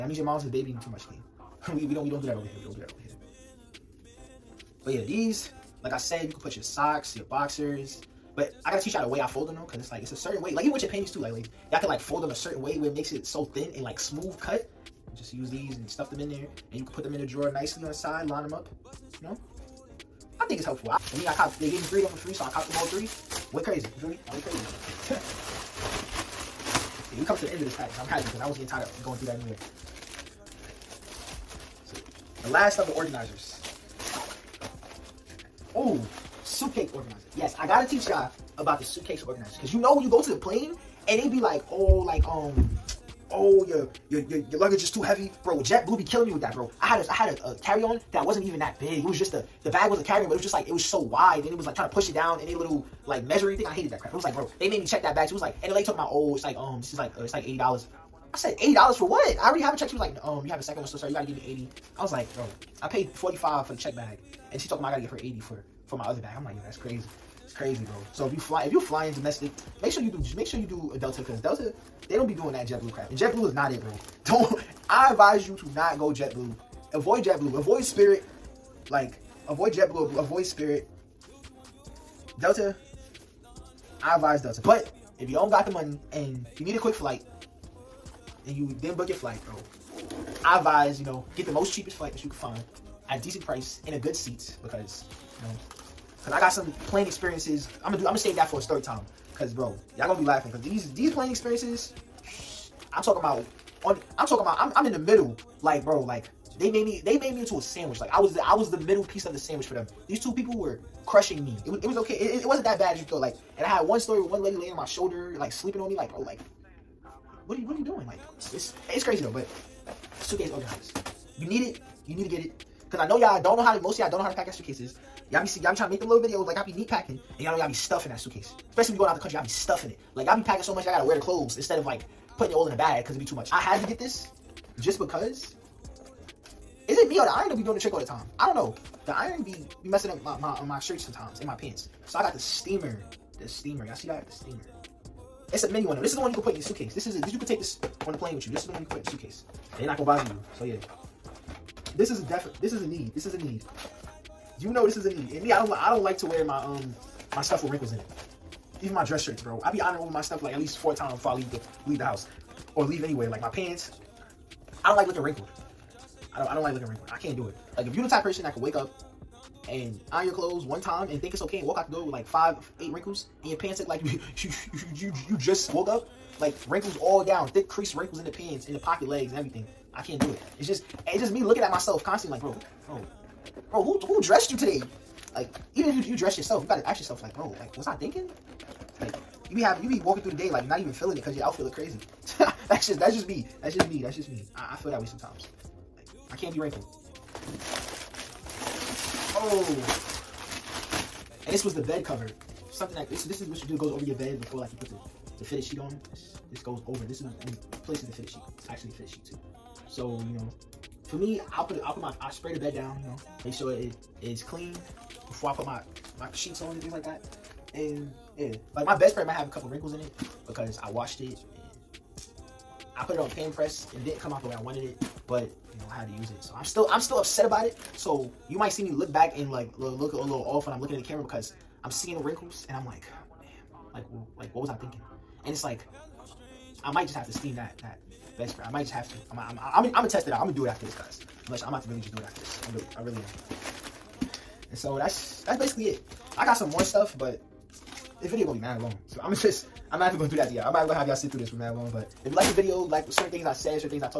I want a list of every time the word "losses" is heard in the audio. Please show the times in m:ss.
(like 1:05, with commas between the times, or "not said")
not said.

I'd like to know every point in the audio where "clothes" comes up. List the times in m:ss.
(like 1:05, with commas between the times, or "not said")
2:11, 2:50.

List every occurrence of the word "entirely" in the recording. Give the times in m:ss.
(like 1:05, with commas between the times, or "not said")
not said.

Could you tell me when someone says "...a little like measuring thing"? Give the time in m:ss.
0:52.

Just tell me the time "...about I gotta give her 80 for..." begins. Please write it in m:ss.
1:04.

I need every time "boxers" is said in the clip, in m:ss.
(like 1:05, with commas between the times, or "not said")
0:07.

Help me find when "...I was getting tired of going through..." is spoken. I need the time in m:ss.
0:28.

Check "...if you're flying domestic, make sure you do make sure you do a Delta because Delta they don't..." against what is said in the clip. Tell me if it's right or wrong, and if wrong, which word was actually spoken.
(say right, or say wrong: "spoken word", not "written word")
right.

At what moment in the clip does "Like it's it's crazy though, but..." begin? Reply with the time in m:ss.
1:58.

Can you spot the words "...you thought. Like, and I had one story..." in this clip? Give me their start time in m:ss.
1:52.